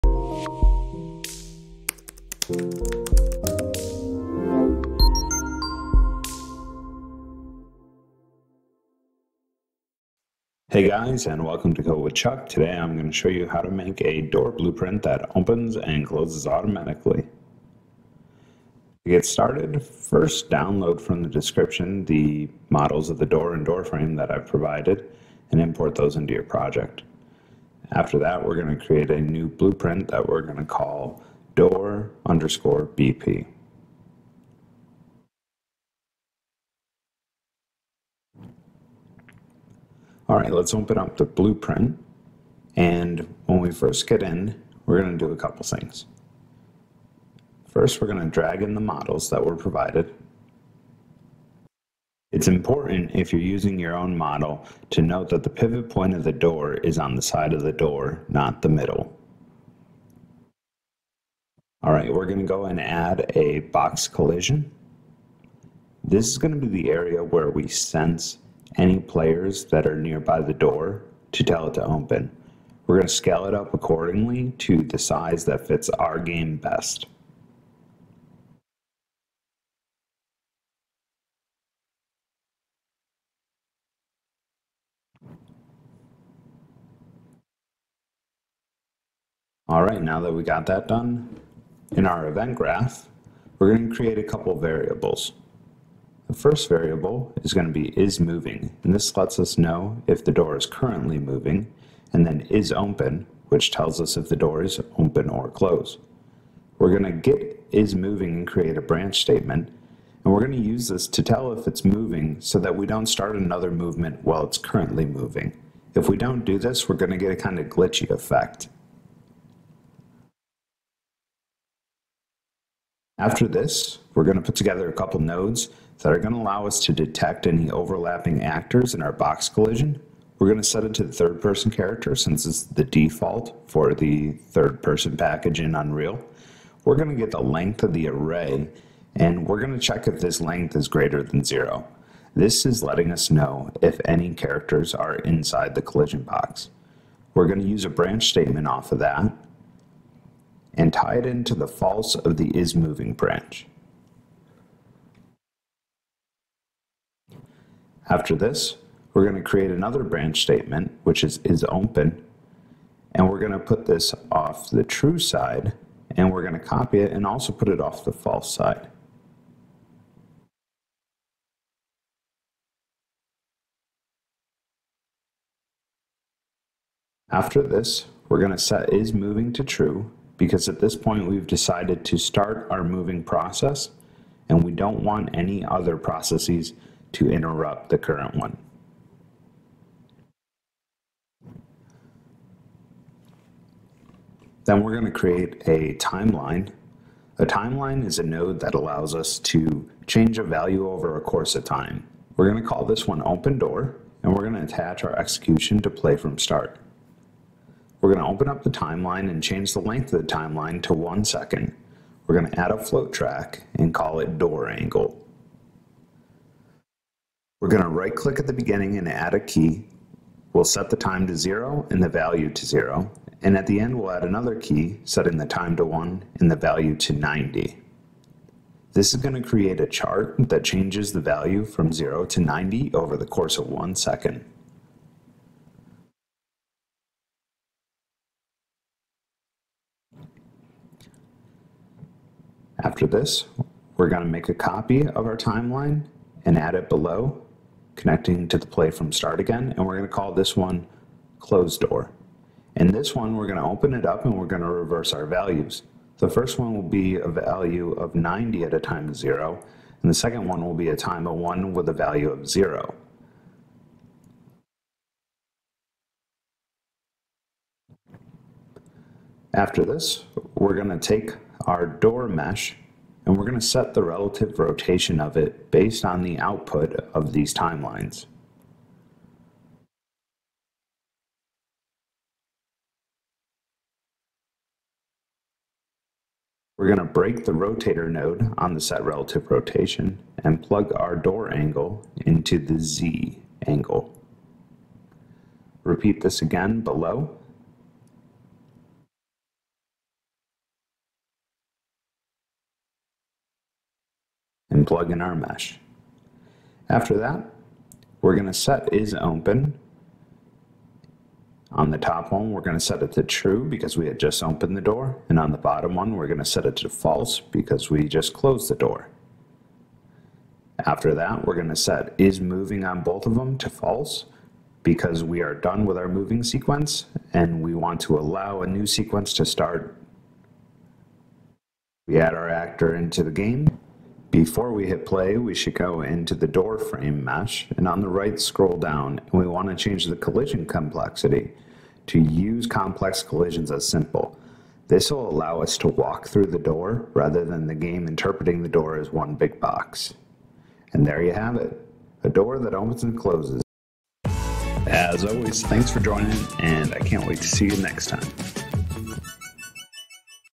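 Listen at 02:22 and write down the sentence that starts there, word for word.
This is letting us know if any characters are inside the collision box.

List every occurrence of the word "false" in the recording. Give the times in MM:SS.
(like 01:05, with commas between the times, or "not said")
02:31, 02:48, 05:16, 05:23.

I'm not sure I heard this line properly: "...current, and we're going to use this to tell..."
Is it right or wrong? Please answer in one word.
wrong.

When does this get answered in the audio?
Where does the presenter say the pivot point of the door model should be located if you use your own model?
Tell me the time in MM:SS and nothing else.
00:56.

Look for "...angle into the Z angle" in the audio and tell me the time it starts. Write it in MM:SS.
04:51.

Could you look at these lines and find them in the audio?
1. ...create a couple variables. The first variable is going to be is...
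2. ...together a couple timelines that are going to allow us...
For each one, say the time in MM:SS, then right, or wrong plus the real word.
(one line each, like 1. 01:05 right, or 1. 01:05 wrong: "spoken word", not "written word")
1. 01:33 right
2. 02:04 wrong: "nodes", not "timelines".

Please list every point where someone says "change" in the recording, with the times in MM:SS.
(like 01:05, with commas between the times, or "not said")
03:20, 03:29, 03:50, 05:39.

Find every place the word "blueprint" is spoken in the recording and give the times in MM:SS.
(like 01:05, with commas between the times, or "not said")
00:14, 00:29, 00:41.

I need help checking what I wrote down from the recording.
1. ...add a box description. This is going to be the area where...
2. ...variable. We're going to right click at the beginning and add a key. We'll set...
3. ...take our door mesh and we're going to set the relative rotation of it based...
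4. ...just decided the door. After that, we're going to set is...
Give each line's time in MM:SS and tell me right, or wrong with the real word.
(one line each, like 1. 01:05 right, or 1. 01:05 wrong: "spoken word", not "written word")
1. 01:02 wrong: "collision", not "description"
2. 03:34 wrong: "angle", not "variable"
3. 04:30 right
4. 05:18 wrong: "closed", not "decided".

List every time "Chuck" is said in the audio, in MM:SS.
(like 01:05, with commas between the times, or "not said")
00:12.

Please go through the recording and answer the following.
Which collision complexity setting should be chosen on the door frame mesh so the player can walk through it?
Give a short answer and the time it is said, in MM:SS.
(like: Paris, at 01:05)
use complex collisions as simple, at 05:42.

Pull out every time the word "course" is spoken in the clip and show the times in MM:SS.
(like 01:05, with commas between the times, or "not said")
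03:21, 03:53.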